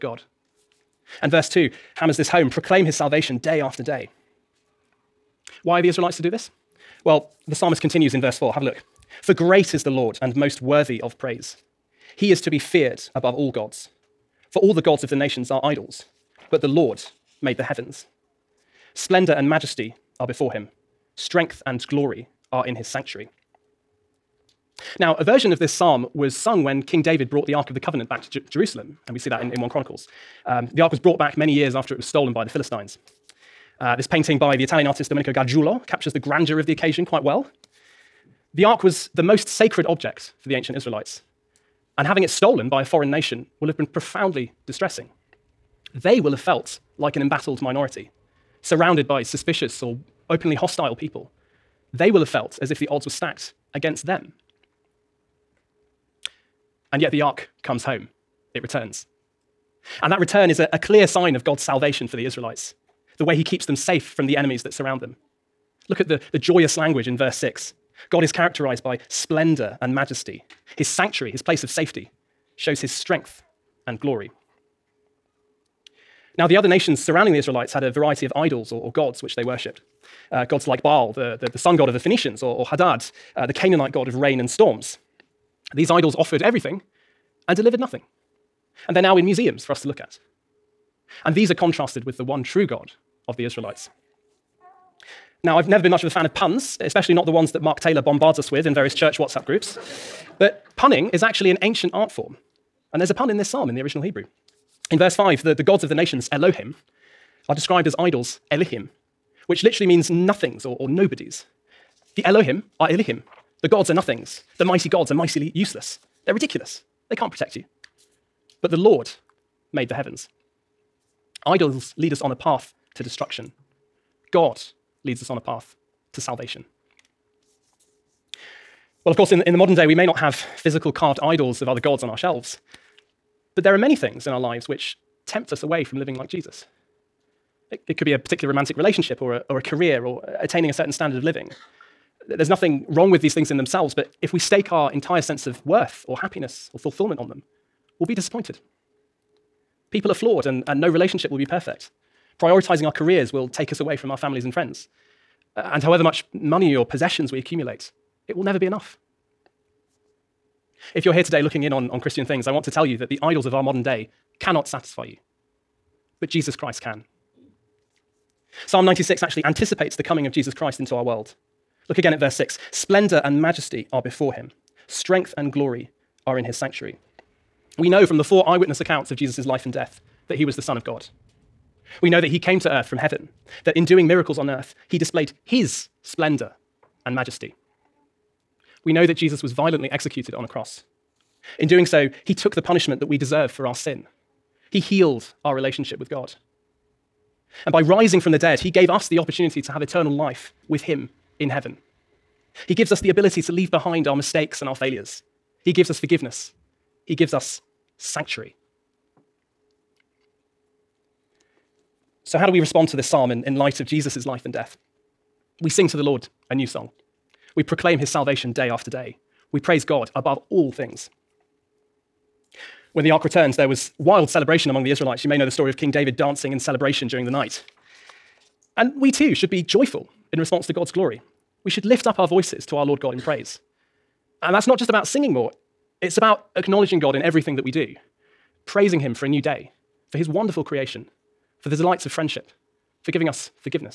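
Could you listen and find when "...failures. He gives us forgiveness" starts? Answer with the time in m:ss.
3:24.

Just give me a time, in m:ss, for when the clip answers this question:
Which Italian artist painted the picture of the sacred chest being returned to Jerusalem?
0:35.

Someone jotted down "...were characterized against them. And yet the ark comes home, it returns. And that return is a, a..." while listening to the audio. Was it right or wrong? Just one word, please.
wrong.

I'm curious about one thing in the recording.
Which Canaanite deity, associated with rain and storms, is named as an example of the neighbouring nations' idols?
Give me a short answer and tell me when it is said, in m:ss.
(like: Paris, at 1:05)
Hadad, at 1:22.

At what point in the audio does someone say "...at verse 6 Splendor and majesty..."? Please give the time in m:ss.
2:52.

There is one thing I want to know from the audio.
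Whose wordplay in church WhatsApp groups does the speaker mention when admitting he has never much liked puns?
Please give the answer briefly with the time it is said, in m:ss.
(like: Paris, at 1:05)
Mark Taylor, at 1:37.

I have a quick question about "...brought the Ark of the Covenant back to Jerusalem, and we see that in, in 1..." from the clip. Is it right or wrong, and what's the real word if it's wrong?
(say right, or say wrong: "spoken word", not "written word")
right.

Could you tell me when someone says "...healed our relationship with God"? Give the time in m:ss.
3:14.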